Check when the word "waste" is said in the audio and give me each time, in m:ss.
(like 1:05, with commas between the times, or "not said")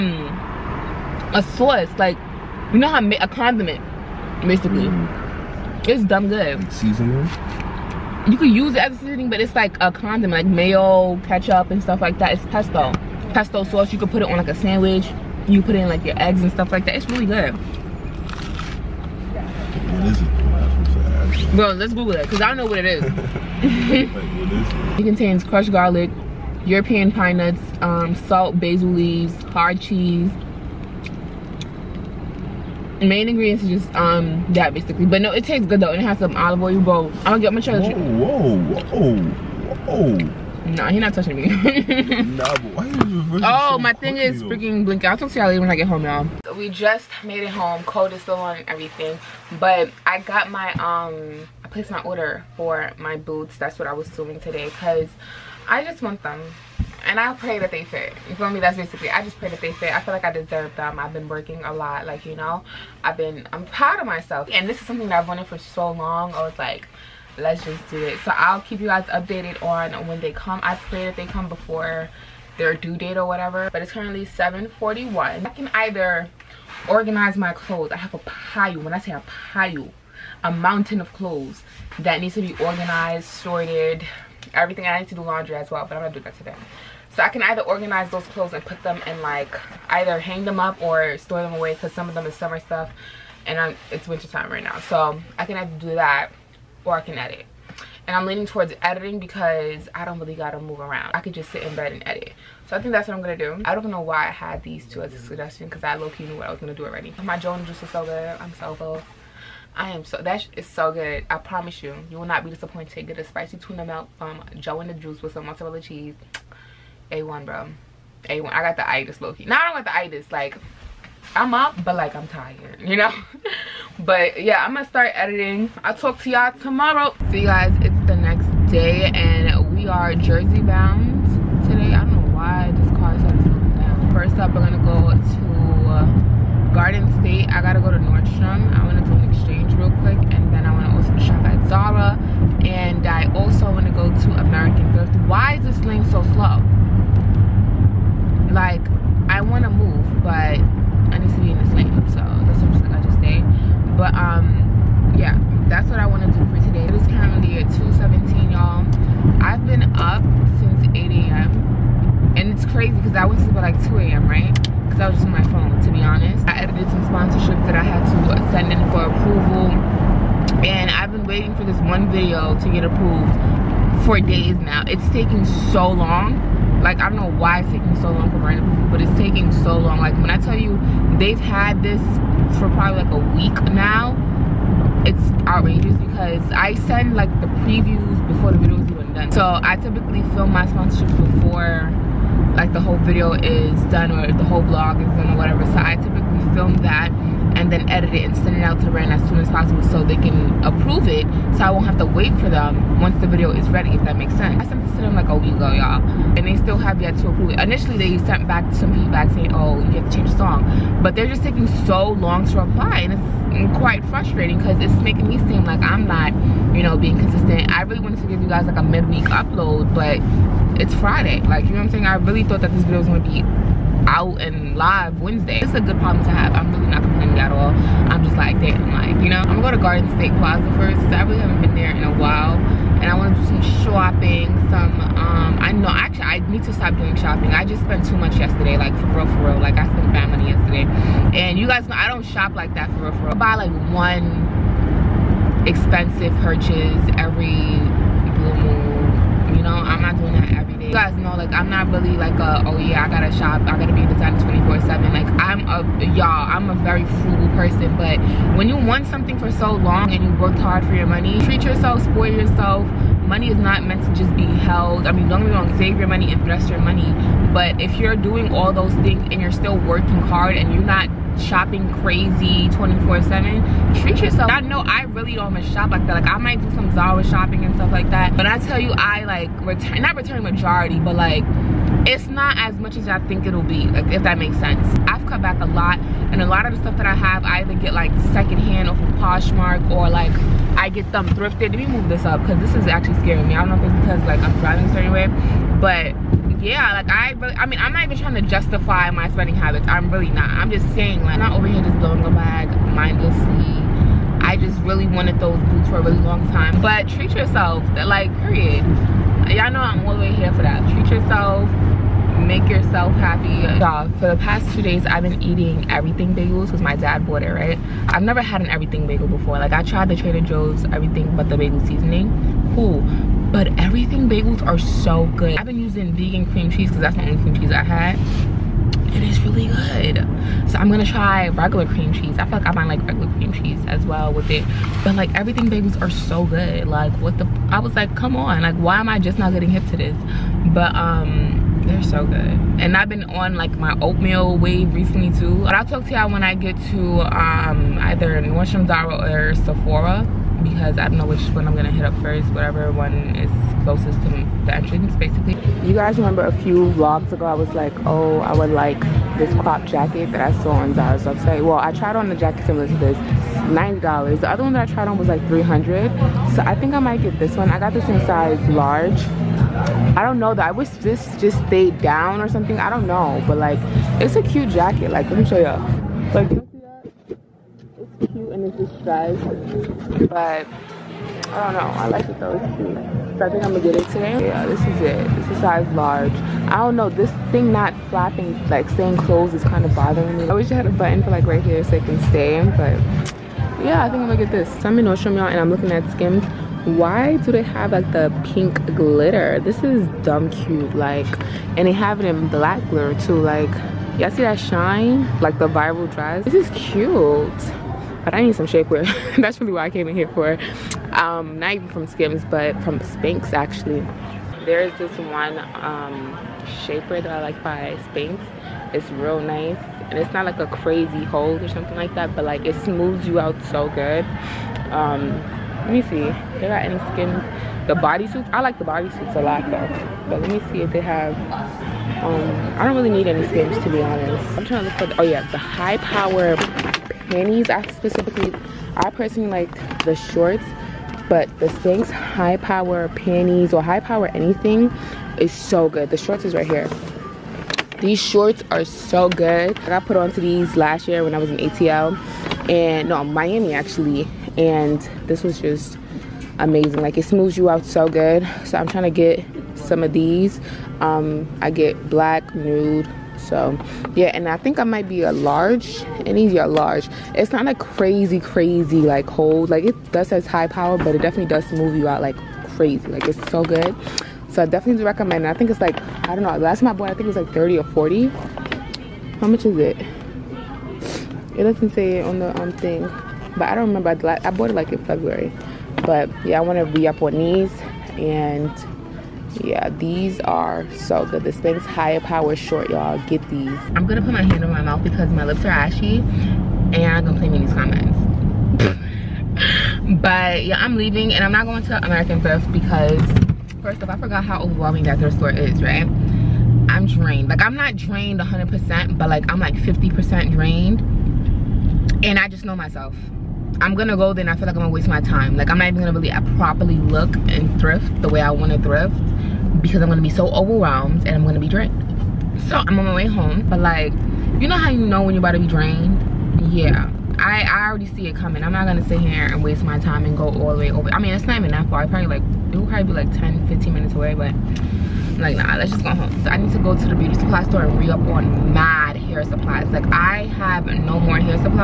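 8:34, 8:49.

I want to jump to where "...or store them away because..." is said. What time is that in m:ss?
1:30.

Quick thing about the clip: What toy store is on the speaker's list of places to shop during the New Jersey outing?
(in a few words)
American Girl.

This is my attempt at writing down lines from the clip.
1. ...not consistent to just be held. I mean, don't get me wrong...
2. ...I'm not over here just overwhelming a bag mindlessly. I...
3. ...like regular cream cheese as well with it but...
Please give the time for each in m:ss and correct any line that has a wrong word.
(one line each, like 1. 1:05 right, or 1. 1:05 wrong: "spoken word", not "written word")
1. 4:23 wrong: "meant", not "consistent"
2. 5:01 wrong: "blowing", not "overwhelming"
3. 5:32 right.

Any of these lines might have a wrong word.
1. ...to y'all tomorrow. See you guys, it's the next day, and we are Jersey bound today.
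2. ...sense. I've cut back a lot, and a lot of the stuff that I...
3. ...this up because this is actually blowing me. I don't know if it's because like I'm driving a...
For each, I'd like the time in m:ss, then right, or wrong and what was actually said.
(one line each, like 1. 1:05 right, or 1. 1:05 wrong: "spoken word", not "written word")
1. 2:06 right
2. 4:44 right
3. 4:52 wrong: "scaring", not "blowing".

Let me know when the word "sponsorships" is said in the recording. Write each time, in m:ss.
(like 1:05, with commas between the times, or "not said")
2:47, 3:10.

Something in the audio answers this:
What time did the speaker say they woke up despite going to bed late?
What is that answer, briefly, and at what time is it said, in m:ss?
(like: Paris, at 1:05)
8 a.m., at 2:40.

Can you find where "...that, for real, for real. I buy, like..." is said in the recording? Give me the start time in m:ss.
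4:02.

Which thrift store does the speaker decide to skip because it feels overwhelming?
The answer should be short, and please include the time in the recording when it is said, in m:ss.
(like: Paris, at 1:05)
American Thrift, at 8:22.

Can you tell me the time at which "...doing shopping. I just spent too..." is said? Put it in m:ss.
3:56.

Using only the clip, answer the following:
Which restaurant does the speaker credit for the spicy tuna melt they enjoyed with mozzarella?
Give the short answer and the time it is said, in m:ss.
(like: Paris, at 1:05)
Joe and the Juice, at 1:54.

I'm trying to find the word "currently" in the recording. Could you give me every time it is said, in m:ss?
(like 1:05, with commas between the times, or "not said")
1:13, 2:37.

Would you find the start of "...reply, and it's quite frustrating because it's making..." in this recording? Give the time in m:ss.
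3:32.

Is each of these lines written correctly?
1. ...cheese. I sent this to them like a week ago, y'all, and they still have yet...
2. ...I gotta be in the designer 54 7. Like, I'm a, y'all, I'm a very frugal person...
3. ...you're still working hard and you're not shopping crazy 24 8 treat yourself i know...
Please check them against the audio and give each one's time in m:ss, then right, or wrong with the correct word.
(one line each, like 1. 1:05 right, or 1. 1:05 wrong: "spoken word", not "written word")
1. 3:24 wrong: "sense", not "cheese"
2. 4:13 wrong: "24", not "54"
3. 4:29 wrong: "7", not "8".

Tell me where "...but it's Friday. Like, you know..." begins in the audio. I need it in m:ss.
3:39.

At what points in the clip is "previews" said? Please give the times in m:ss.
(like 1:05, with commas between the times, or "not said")
3:07.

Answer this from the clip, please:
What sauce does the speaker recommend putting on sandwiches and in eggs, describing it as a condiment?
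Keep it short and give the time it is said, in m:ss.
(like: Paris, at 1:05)
Pesto, at 0:12.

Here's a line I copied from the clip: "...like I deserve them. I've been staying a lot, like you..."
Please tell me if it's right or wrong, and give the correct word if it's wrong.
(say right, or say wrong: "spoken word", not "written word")
wrong: "working", not "staying".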